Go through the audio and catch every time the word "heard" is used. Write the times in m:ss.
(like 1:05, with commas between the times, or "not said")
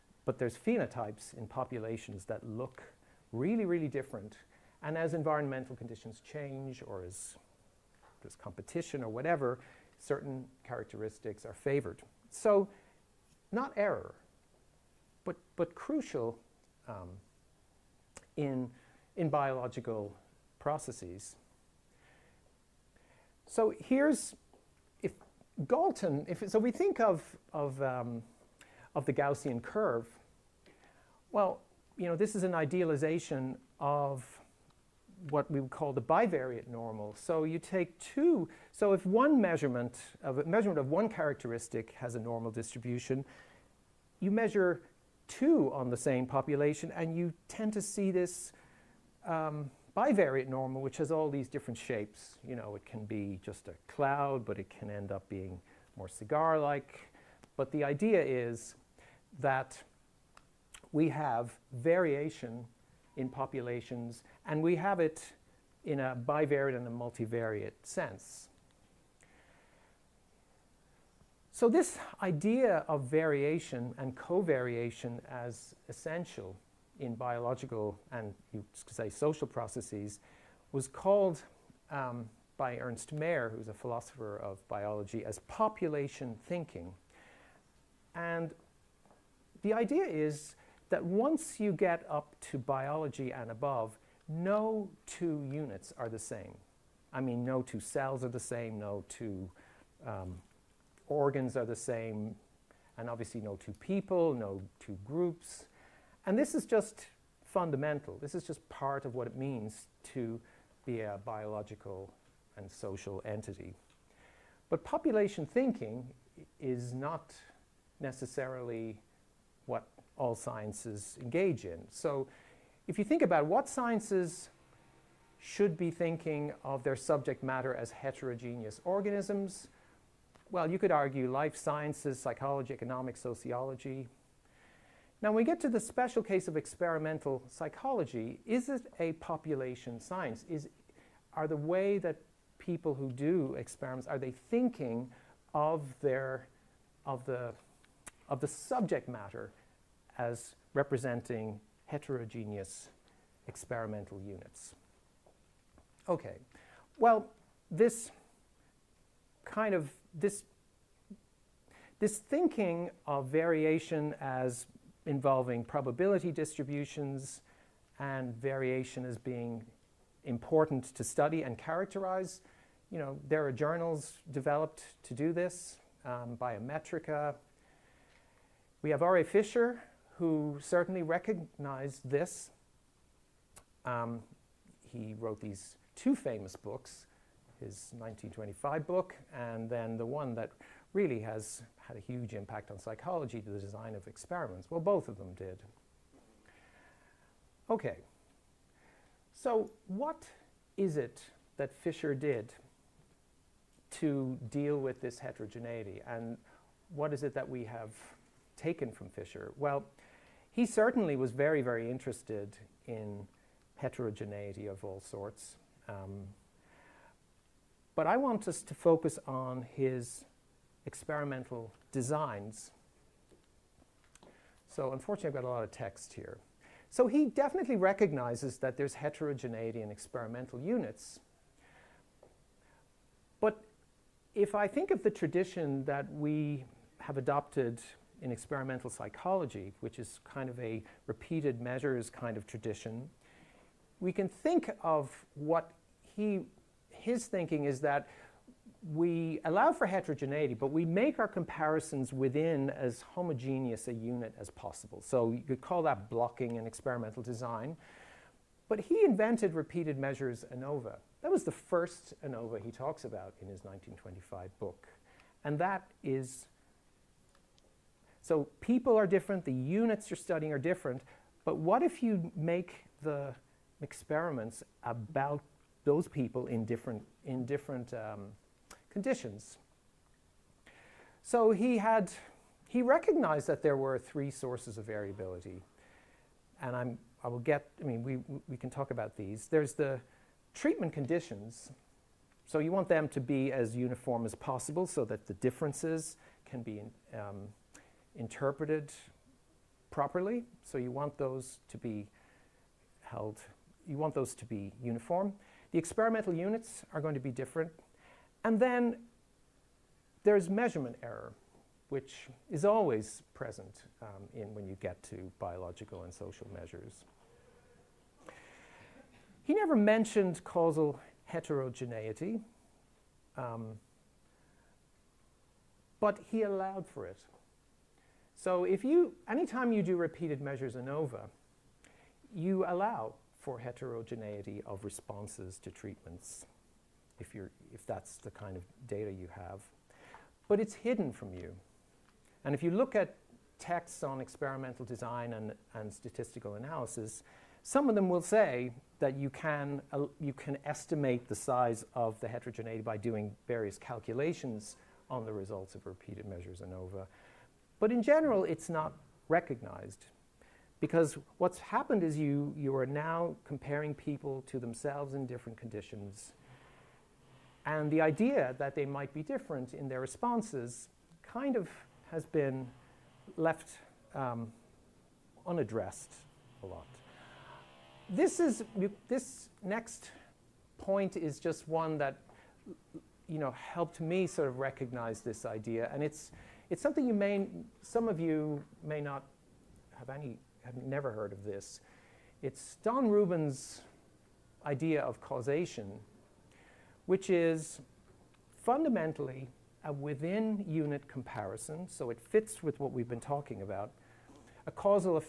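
6:31.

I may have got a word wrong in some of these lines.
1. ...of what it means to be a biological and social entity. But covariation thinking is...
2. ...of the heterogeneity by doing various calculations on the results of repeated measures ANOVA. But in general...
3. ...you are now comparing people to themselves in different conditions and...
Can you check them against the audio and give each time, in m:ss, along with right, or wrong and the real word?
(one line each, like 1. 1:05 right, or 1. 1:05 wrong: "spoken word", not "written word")
1. 1:49 wrong: "population", not "covariation"
2. 5:51 right
3. 6:02 right.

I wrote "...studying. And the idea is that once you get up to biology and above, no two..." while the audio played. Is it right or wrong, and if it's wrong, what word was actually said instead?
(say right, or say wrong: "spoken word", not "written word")
wrong: "thinking", not "studying".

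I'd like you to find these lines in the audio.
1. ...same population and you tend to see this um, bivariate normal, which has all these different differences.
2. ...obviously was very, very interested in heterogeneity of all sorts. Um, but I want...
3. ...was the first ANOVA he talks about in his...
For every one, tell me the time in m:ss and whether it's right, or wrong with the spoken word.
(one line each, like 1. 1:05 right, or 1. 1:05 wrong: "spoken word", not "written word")
1. 0:45 wrong: "shapes", not "differences"
2. 3:30 wrong: "certainly", not "obviously"
3. 4:21 right.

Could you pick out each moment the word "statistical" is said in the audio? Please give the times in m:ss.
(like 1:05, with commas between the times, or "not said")
5:45.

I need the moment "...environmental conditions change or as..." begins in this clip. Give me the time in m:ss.
0:05.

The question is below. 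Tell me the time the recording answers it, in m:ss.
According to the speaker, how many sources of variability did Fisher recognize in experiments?
4:43.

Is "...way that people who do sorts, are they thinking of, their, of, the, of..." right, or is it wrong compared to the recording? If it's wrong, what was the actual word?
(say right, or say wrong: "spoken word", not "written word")
wrong: "experiments", not "sorts".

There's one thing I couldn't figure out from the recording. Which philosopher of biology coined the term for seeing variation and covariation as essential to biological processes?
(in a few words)
Ernst Mayr.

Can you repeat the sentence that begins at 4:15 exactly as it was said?
So you could call that blocking and experimental design.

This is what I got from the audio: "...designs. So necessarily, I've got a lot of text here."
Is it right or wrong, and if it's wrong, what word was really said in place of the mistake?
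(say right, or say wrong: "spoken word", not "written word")
wrong: "unfortunately", not "necessarily".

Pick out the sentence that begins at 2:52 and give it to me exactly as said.
You know, there are journals developed to do this, um, Biometrika.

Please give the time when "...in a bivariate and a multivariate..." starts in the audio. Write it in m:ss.
1:05.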